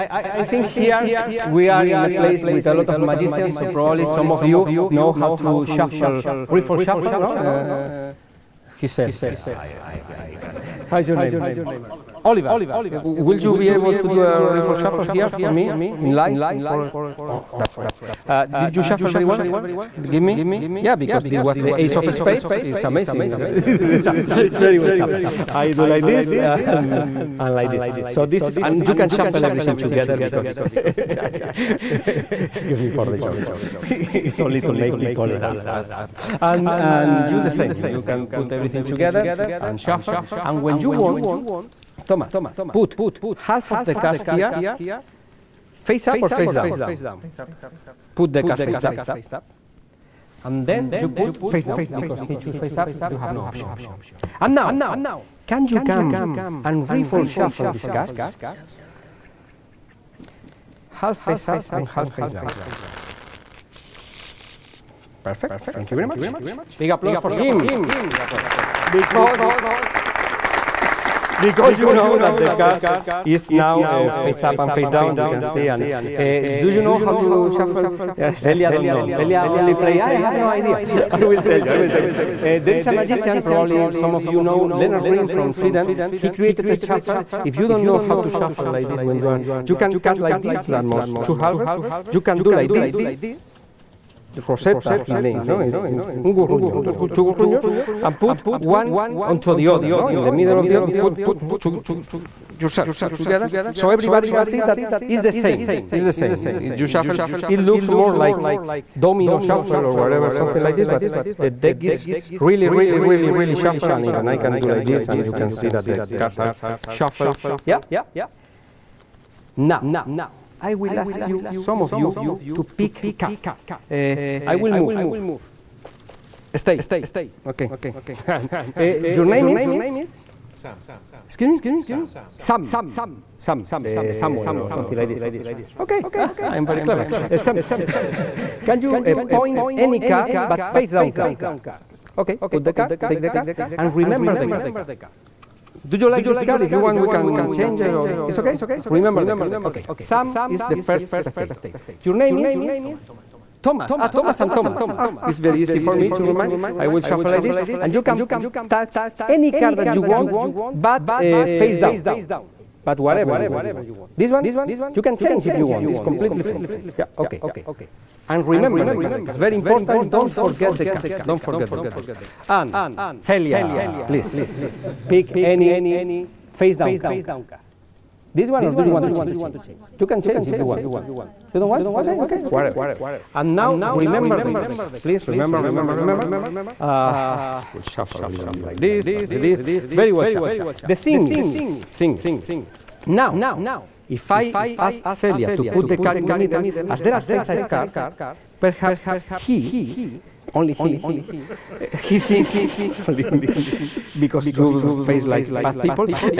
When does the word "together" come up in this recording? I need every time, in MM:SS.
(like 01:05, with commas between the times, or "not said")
00:29, 00:38, 01:43.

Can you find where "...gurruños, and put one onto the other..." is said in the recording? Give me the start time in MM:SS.
01:37.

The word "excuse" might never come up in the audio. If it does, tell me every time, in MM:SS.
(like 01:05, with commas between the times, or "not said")
00:30, 02:11.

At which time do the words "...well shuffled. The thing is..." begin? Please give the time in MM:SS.
03:10.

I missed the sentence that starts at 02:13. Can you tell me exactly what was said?
Sam, uh, Samuel or something like this.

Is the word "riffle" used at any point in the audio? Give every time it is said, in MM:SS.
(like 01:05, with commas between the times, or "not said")
00:06, 00:14, 00:56.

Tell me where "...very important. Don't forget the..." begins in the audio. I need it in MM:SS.
02:49.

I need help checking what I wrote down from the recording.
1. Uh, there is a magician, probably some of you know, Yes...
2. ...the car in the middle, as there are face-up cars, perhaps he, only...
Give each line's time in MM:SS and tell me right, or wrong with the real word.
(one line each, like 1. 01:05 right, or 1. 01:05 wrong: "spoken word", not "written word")
1. 01:22 wrong: "Lennart", not "Yes"
2. 03:15 right.